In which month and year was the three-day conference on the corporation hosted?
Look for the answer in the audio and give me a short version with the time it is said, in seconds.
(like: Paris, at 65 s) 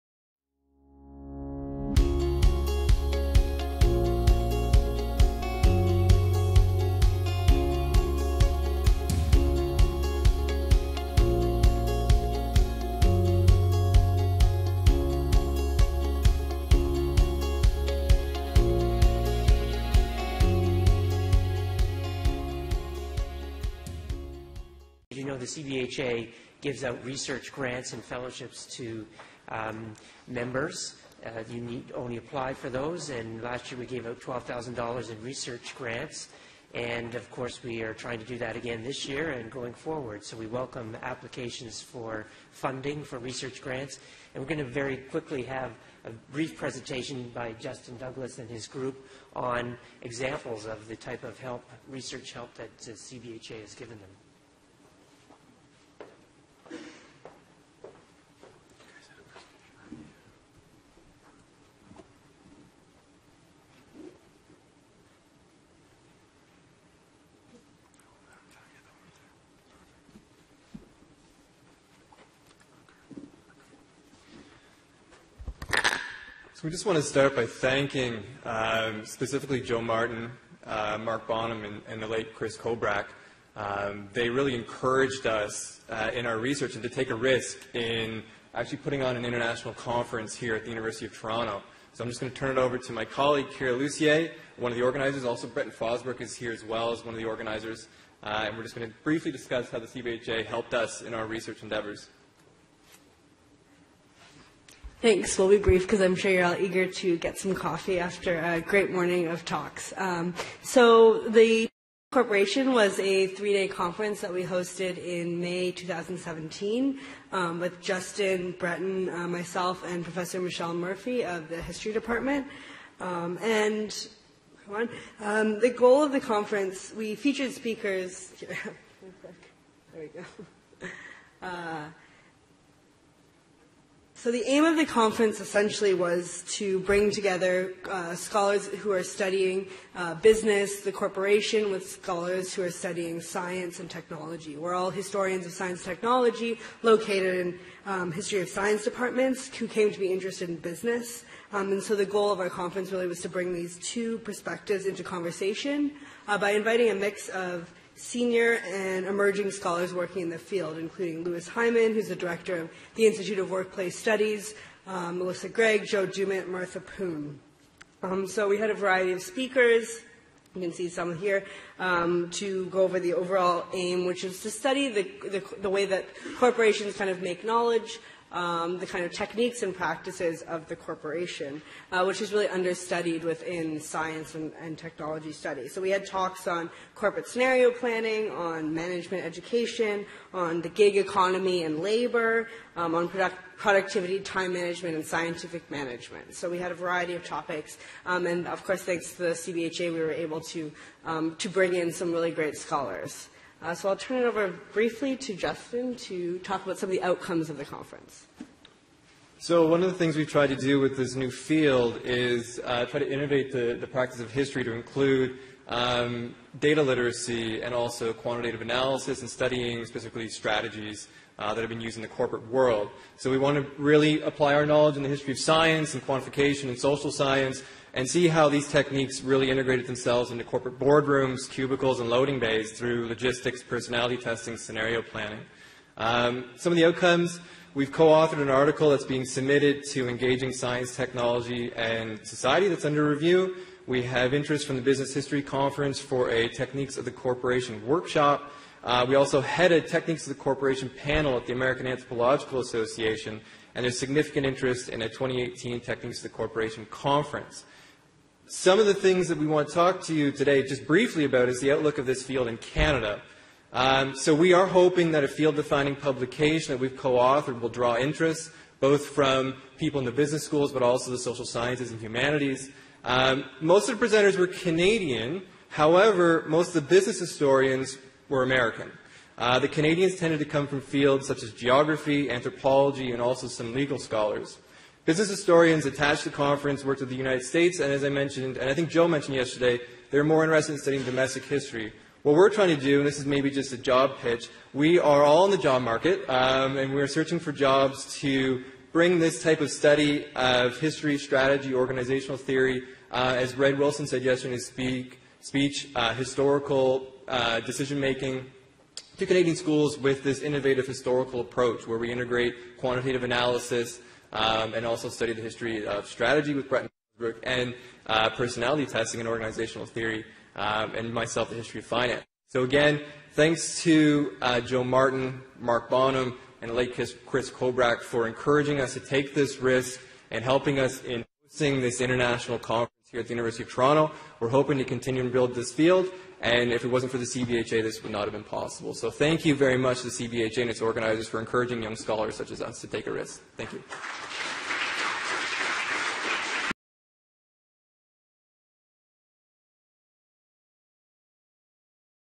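May 2017, at 115 s.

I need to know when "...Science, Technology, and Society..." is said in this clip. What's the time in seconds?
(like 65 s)
240 s.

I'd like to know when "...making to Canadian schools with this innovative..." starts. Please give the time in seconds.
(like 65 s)
307 s.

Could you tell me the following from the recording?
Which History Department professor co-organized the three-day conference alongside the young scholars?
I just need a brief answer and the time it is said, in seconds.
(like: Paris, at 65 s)
Michelle Murphy, at 120 s.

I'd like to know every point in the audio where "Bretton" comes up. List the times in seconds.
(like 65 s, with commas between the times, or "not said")
95 s, 118 s, 316 s.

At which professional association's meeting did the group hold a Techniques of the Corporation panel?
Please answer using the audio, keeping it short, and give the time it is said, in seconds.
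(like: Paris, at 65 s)
American Anthropological Association, at 251 s.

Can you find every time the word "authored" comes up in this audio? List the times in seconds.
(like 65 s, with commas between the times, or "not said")
237 s, 266 s.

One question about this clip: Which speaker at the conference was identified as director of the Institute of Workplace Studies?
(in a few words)
Louis Hyman.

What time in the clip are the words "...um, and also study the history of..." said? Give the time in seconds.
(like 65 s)
314 s.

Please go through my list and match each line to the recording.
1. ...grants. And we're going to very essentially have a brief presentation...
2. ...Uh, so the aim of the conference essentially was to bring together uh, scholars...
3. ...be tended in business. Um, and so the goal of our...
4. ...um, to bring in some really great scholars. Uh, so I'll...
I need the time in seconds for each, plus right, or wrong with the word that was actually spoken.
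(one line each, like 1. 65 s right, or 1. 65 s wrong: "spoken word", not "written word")
1. 43 s wrong: "quickly", not "essentially"
2. 131 s right
3. 149 s wrong: "interested", not "tended"
4. 201 s right.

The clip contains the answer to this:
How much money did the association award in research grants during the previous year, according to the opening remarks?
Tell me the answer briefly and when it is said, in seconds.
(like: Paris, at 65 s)
$12,000, at 34 s.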